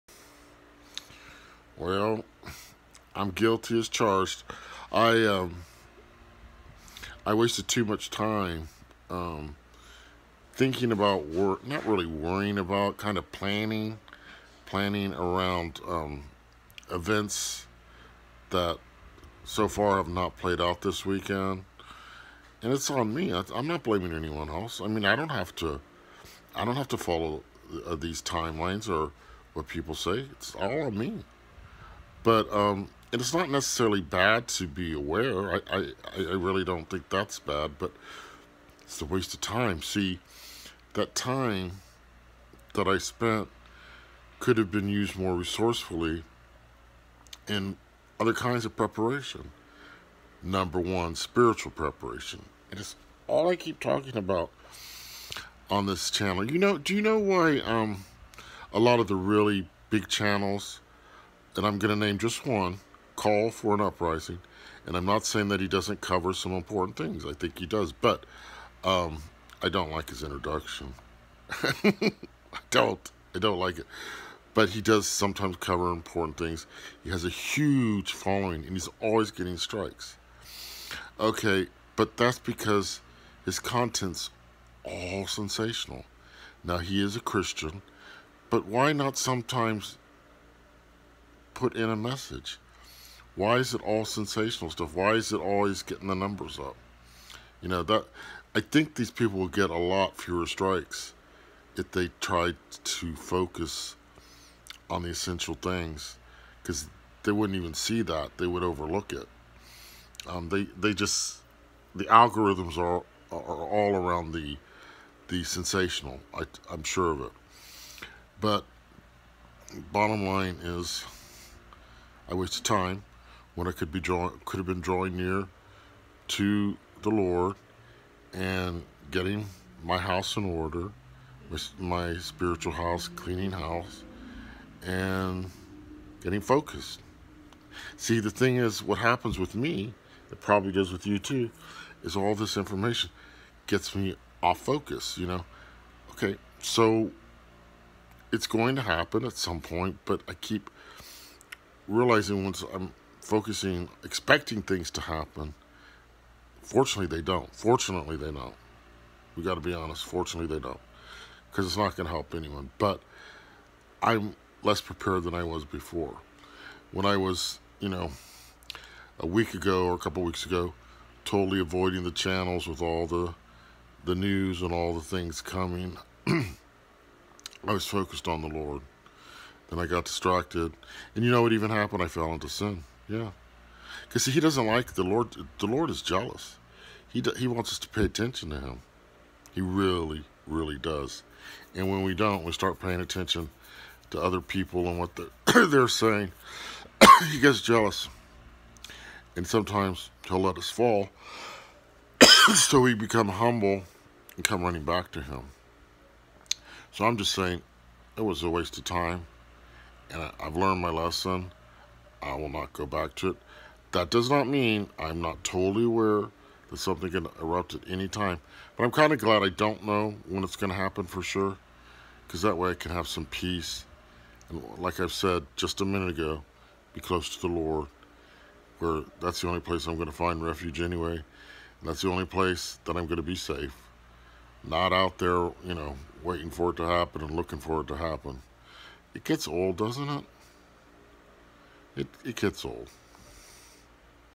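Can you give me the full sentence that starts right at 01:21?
Okay, but that's because his content's all sensational.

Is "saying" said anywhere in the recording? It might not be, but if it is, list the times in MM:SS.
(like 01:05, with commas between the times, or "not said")
01:05, 03:15, 03:27.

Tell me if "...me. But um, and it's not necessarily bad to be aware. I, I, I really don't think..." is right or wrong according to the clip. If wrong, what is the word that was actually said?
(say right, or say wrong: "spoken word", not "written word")
right.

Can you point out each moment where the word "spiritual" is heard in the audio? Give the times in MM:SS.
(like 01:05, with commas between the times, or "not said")
00:51, 02:12.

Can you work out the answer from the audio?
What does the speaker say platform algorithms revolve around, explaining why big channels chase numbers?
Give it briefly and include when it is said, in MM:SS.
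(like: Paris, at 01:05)
The sensational, at 01:55.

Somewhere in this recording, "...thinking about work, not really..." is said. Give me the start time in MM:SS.
00:10.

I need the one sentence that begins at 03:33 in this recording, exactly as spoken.
That does not mean I'm not totally aware that something can erupt at any time.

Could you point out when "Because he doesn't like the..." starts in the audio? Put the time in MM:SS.
03:04.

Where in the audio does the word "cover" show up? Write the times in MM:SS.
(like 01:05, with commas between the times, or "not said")
01:06, 01:15.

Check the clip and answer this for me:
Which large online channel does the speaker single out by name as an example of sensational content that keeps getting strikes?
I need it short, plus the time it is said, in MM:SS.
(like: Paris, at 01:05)
Call for an Uprising, at 01:03.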